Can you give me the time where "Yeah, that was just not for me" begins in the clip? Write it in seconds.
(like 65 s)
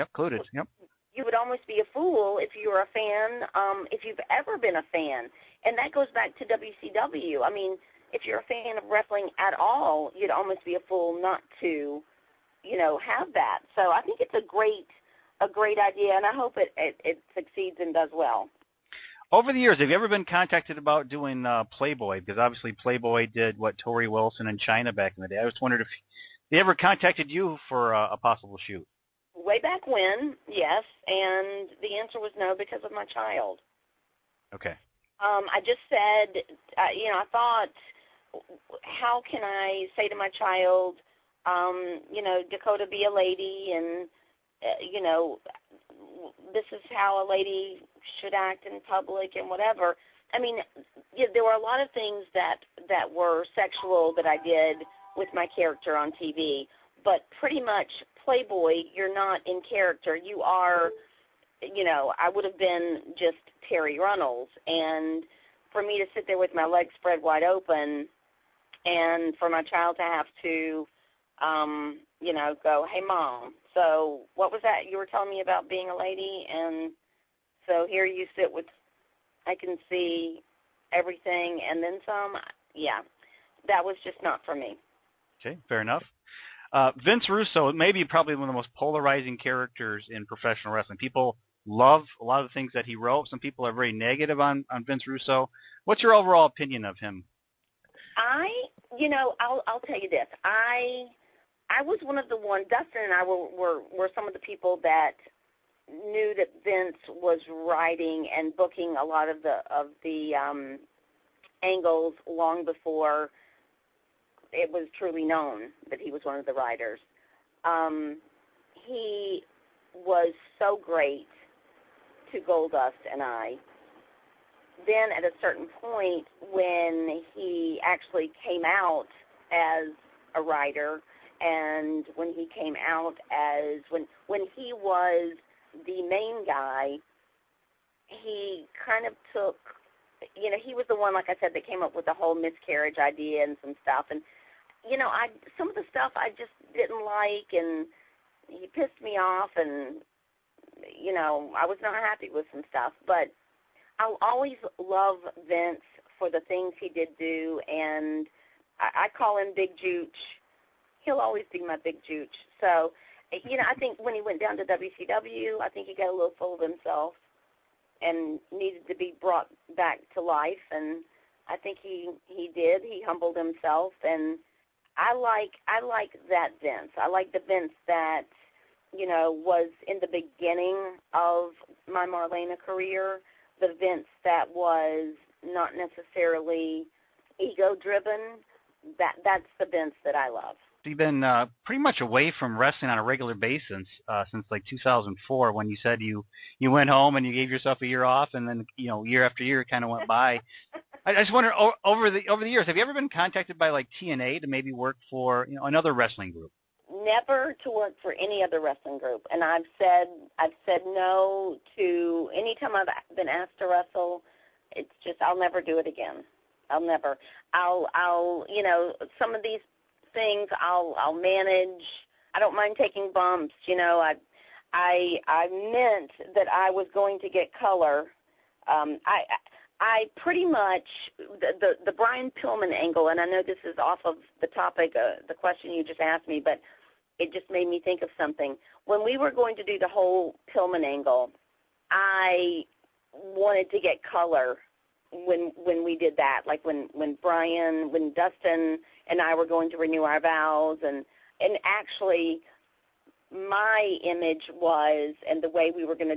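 82 s.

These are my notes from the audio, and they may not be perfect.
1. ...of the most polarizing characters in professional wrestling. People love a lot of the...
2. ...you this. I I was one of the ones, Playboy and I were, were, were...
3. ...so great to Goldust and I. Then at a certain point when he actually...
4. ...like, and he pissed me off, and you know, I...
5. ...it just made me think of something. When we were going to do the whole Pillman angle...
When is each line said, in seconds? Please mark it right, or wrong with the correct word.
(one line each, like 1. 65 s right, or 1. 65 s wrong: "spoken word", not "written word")
1. 88 s right
2. 99 s wrong: "Dustin", not "Playboy"
3. 120 s right
4. 147 s right
5. 237 s right.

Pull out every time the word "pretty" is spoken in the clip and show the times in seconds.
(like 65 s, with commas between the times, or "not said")
57 s, 191 s, 230 s.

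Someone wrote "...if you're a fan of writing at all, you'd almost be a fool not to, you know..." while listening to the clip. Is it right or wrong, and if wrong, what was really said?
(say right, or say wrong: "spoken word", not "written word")
wrong: "wrestling", not "writing".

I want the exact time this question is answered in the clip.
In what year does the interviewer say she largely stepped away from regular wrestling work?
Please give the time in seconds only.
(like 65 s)
194 s.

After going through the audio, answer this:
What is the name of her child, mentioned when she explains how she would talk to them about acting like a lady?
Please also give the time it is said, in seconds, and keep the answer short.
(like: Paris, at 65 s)
Dakota, at 42 s.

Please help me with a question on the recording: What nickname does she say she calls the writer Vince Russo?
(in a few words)
Big Jooch.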